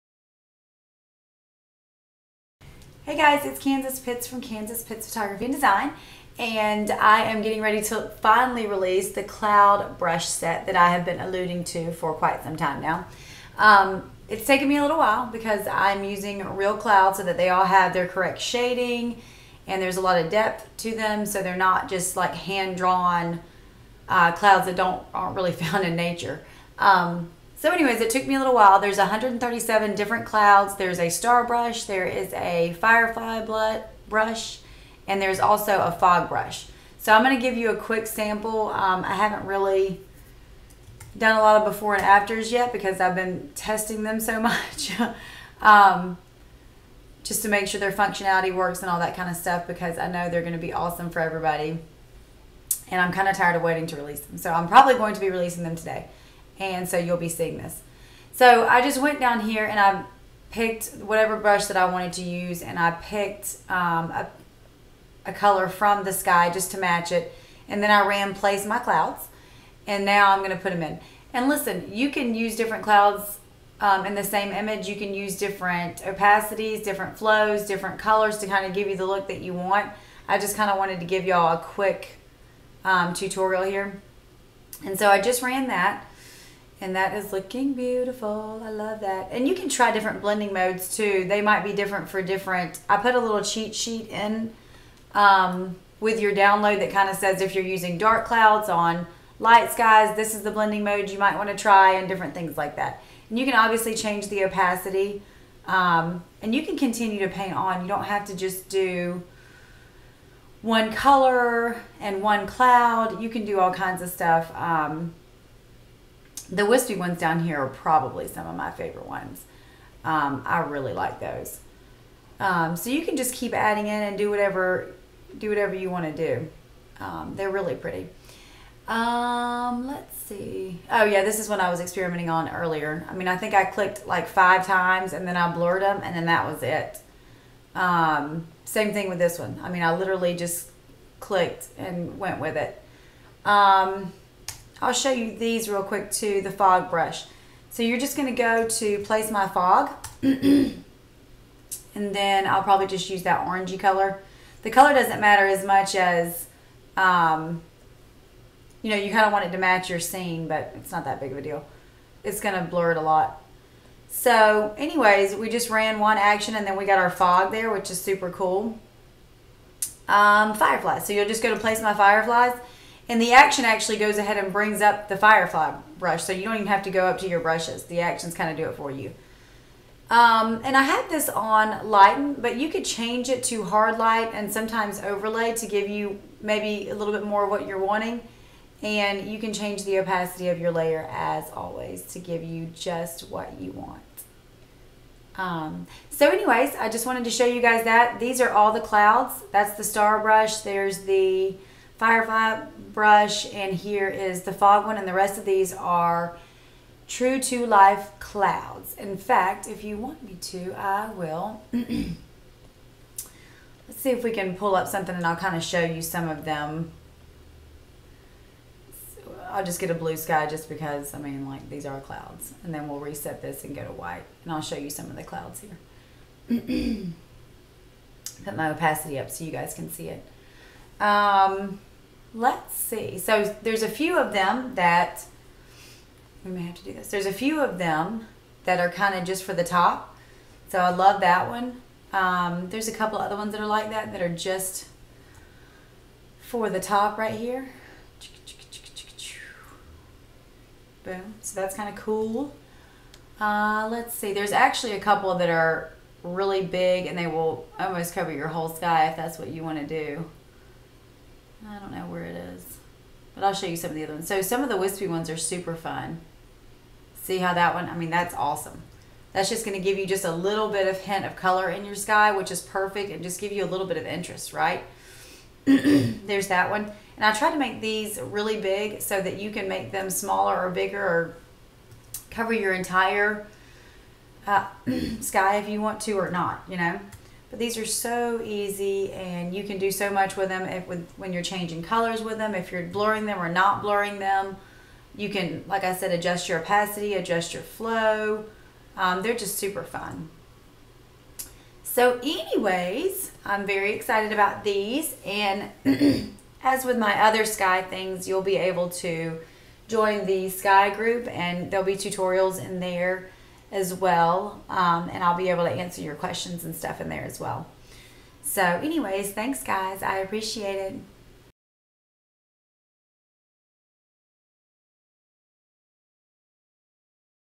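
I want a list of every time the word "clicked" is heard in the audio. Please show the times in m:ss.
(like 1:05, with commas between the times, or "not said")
2:13, 2:21.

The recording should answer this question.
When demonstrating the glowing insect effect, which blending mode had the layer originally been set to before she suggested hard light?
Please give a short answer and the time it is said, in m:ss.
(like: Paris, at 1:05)
Lighten, at 3:01.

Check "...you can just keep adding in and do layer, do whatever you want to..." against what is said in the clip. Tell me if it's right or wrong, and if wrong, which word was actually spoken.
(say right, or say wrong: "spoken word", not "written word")
wrong: "whatever", not "layer".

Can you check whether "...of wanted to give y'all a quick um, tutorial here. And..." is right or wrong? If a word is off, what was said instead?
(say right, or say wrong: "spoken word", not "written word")
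right.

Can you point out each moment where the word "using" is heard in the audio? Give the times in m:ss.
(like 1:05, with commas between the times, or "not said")
0:16, 1:37.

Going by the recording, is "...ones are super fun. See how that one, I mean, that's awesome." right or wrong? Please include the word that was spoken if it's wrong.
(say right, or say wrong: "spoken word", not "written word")
right.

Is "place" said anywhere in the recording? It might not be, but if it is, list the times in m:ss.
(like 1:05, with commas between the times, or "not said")
1:08, 2:28, 2:51.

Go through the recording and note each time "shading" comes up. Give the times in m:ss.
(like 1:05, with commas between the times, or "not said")
0:18.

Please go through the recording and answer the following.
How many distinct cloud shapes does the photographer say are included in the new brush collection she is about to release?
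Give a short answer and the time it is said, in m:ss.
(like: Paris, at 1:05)
137, at 0:28.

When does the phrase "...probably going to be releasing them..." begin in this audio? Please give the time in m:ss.
0:54.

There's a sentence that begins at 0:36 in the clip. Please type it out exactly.
So, I'm going to give you a quick sample.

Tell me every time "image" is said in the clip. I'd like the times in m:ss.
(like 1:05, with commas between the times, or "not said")
1:14.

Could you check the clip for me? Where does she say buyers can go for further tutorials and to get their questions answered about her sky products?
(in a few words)
The sky group.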